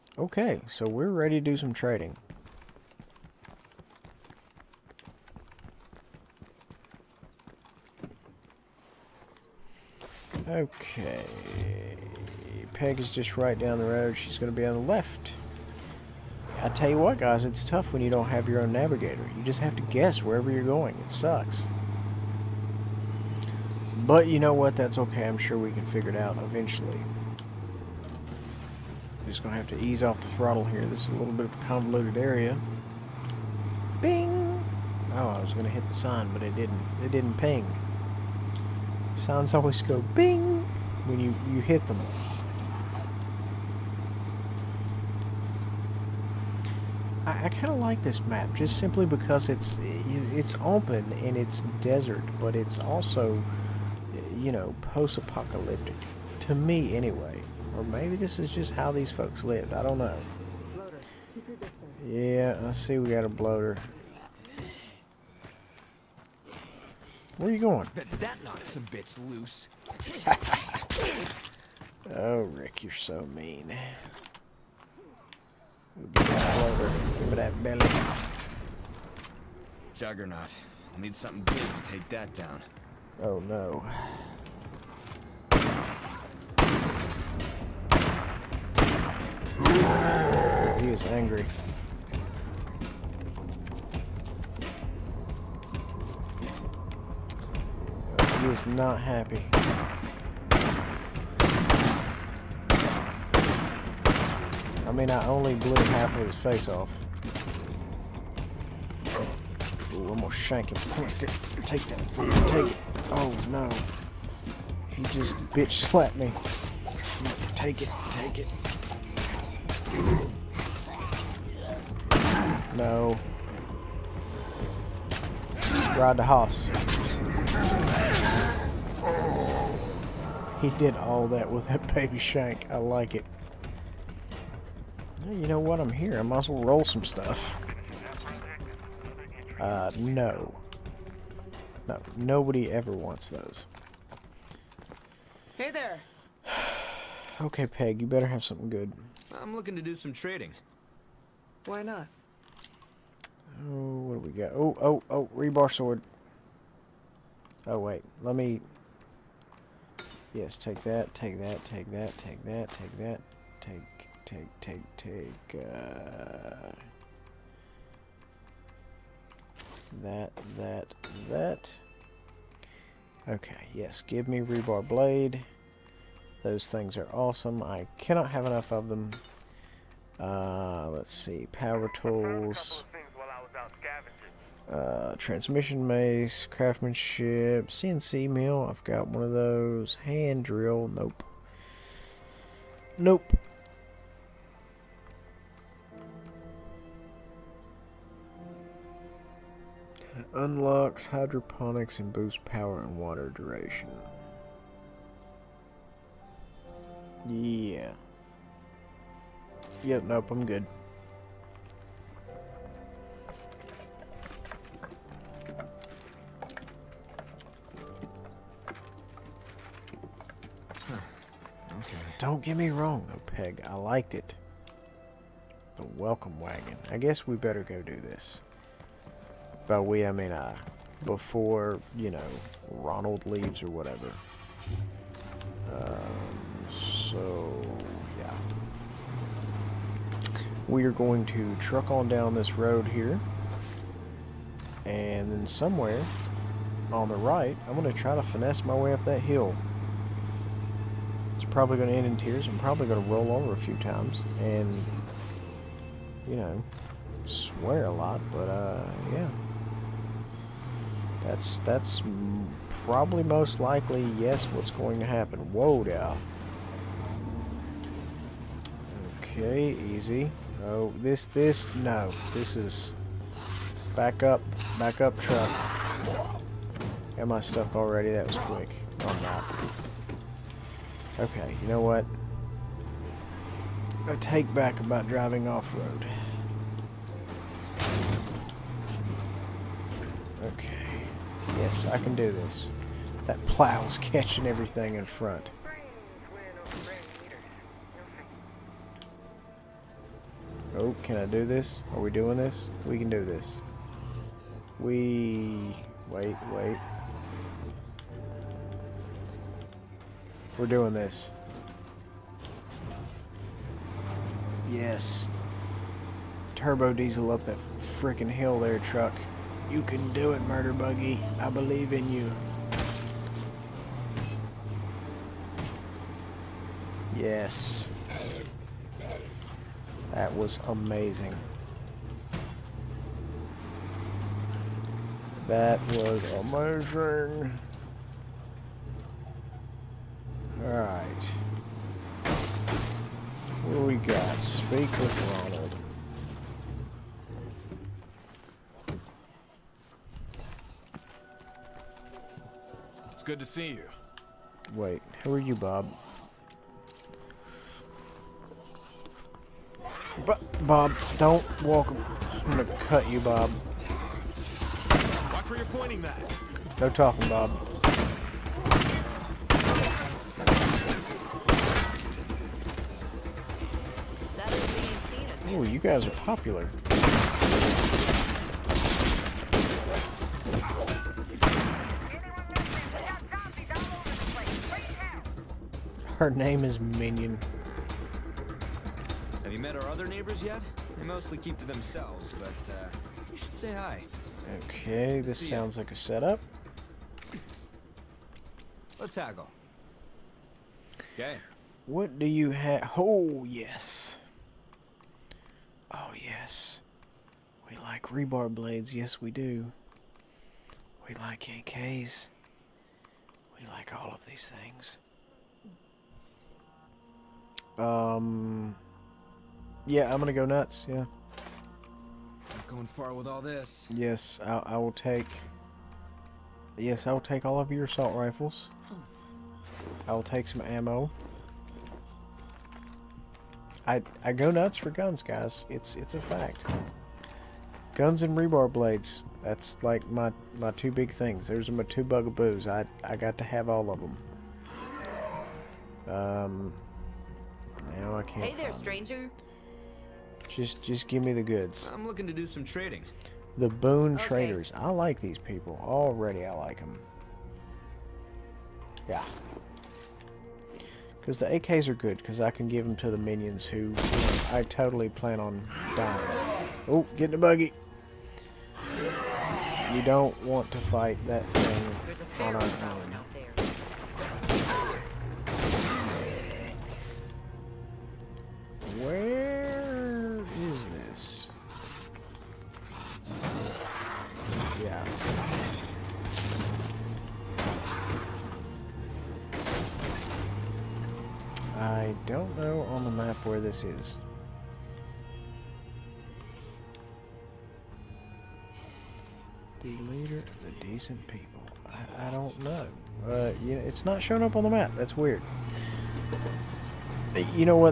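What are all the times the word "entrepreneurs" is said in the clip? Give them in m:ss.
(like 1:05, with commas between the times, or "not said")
not said.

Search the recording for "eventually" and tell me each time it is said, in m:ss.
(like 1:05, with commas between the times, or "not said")
0:26.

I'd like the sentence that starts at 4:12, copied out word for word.
I'm probably going to roll over a few times and, you know, swear a lot.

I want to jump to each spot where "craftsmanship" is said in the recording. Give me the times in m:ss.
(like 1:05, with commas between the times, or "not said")
3:06.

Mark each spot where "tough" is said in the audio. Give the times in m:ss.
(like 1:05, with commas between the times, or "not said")
0:17.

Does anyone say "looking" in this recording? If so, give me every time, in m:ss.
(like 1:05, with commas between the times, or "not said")
2:29, 7:32.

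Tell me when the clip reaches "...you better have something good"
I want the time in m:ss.
2:27.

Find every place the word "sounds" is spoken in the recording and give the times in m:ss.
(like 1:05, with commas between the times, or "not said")
0:39, 6:35.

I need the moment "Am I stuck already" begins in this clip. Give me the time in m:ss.
4:37.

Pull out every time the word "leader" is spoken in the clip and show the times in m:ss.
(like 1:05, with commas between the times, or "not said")
8:20.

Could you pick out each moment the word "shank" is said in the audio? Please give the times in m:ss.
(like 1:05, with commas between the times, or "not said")
1:50, 2:12.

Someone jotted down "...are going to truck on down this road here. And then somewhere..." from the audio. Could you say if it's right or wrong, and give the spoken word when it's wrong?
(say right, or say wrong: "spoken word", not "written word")
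right.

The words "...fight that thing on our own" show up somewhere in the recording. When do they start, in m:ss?
7:50.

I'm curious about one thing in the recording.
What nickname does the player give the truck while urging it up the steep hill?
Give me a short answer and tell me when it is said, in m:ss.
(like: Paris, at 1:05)
Murder Buggy, at 5:20.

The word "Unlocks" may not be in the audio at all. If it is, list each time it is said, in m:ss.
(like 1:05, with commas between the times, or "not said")
3:20.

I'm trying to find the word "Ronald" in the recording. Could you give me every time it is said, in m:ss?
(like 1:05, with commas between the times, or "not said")
3:52, 5:45.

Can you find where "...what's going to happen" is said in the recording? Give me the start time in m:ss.
4:24.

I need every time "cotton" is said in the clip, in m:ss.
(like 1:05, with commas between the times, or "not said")
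not said.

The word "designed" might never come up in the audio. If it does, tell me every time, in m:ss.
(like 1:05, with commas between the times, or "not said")
not said.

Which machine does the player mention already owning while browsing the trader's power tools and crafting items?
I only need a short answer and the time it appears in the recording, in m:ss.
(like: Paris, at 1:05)
CNC mill, at 3:07.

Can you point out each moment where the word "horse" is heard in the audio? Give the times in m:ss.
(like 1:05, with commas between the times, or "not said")
2:06.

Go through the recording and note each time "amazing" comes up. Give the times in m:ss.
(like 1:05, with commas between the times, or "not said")
5:30, 5:36.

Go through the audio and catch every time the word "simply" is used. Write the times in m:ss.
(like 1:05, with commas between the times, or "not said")
0:48.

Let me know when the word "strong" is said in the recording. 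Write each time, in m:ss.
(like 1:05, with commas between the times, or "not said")
not said.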